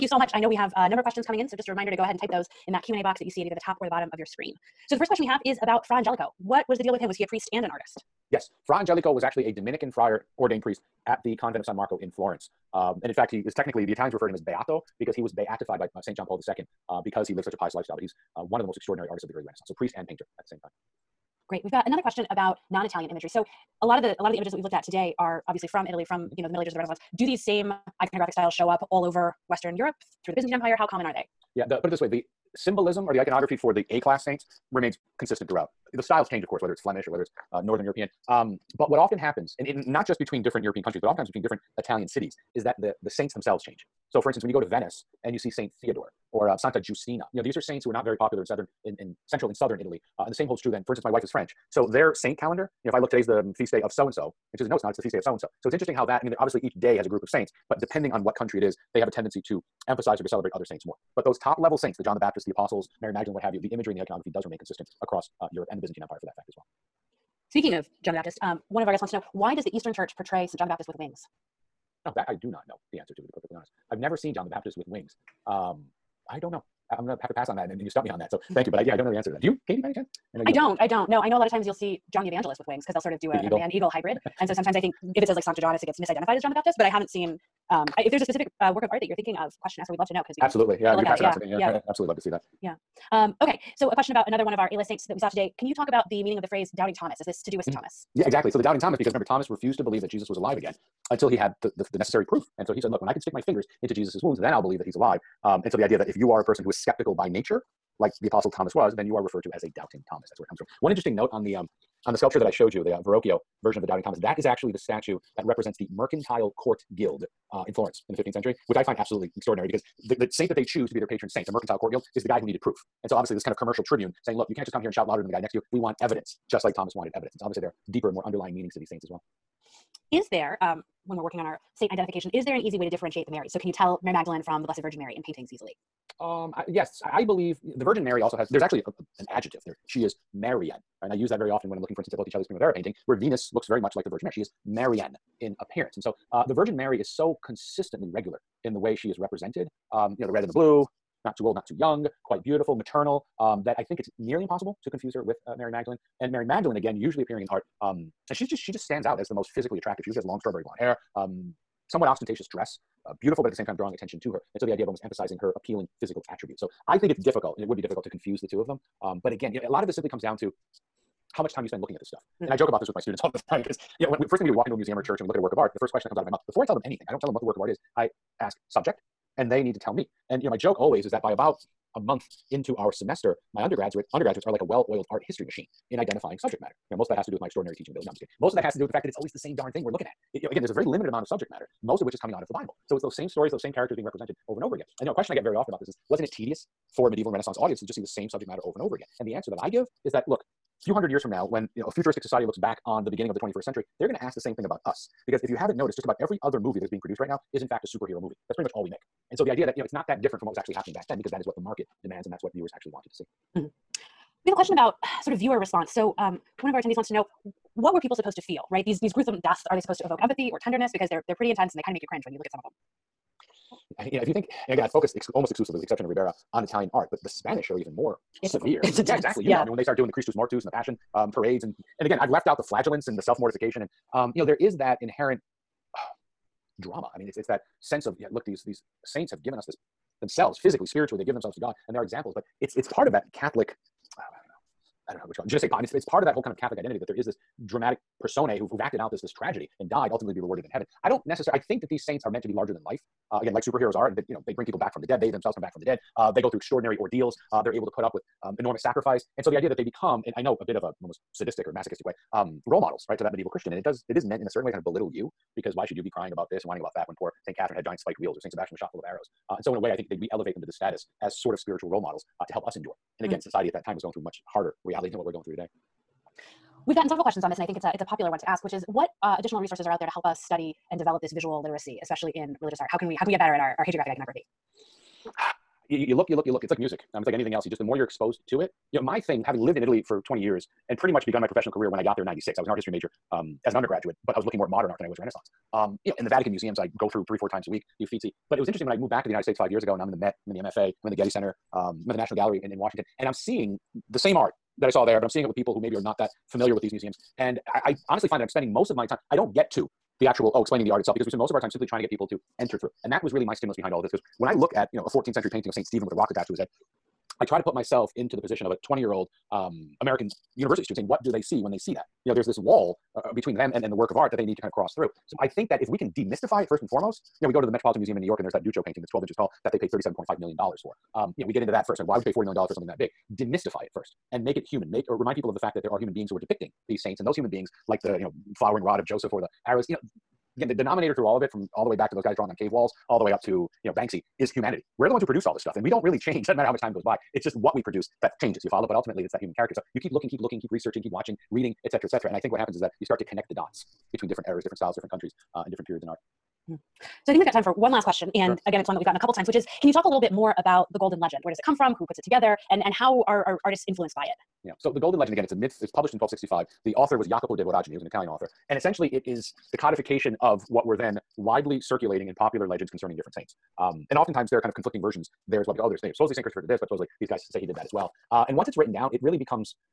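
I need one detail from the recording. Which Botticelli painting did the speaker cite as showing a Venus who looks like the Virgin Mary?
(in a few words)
Primavera.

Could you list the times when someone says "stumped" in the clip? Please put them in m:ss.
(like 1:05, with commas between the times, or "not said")
1:17.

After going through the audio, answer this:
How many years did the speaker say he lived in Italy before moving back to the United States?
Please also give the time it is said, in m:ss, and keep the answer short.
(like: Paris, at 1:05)
20, at 4:50.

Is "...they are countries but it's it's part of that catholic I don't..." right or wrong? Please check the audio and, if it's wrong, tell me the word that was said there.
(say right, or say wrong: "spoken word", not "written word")
wrong: "examples", not "countries".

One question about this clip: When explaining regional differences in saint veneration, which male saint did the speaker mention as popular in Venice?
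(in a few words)
Saint Theodore.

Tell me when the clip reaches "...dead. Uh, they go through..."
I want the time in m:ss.
4:15.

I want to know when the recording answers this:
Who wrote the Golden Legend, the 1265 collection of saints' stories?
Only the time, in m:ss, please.
6:07.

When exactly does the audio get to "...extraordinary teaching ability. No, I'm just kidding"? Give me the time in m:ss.
3:07.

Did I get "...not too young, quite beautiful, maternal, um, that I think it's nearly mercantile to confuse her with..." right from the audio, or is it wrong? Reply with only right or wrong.
wrong.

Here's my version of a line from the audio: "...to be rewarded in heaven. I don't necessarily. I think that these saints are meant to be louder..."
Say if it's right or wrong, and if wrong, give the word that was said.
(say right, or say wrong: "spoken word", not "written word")
wrong: "larger", not "louder".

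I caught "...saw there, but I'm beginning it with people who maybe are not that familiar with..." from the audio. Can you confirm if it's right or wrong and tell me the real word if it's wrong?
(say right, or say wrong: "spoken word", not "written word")
wrong: "seeing", not "beginning".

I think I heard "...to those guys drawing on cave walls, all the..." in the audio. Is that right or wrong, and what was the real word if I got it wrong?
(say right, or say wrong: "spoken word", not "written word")
right.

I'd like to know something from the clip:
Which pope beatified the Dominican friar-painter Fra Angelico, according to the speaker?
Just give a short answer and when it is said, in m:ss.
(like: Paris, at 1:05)
St. John Paul II, at 0:16.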